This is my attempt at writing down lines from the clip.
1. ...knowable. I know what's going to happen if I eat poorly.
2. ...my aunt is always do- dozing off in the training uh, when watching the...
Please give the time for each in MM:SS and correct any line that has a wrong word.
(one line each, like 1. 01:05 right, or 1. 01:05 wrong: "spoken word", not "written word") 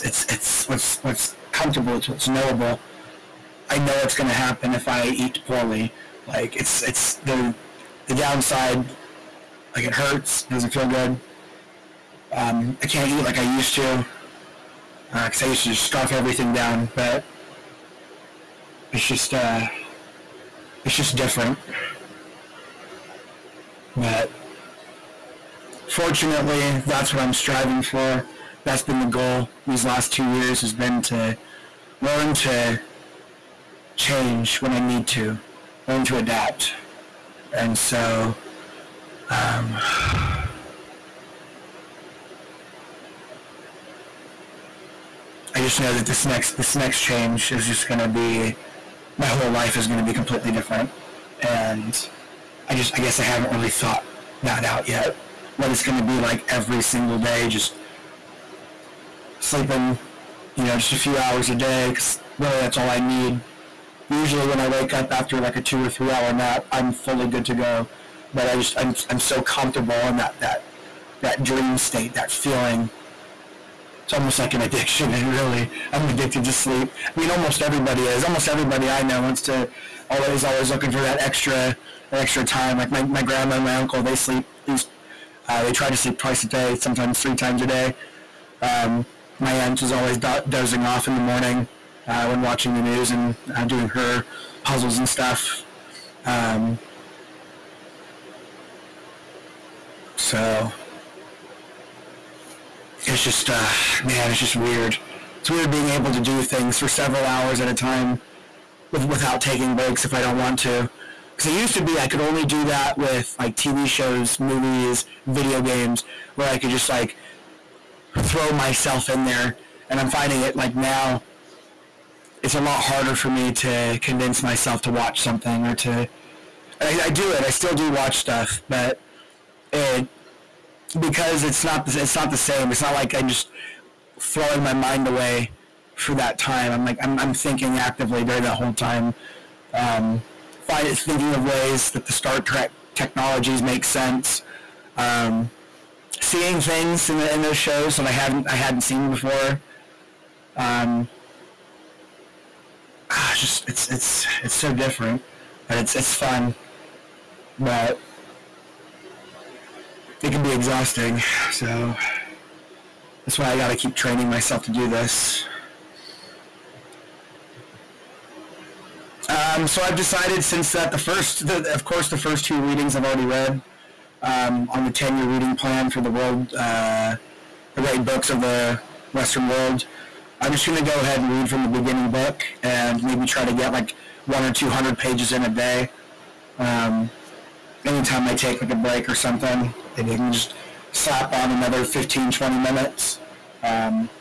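1. 00:02 right
2. 01:29 wrong: "morning", not "training".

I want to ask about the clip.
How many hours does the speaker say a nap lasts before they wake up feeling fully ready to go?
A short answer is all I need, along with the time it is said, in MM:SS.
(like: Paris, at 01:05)
2 or 3 hours, at 01:05.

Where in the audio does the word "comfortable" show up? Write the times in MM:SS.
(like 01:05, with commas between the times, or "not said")
00:01, 01:09.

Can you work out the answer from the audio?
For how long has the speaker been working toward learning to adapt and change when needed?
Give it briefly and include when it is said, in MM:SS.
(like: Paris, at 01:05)
2 years, at 00:30.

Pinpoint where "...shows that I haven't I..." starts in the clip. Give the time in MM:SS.
02:27.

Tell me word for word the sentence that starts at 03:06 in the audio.
Um, anytime I take like a break or something.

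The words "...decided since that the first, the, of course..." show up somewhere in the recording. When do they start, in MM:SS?
02:49.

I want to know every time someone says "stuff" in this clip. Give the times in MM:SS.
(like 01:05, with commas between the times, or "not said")
01:35, 02:08.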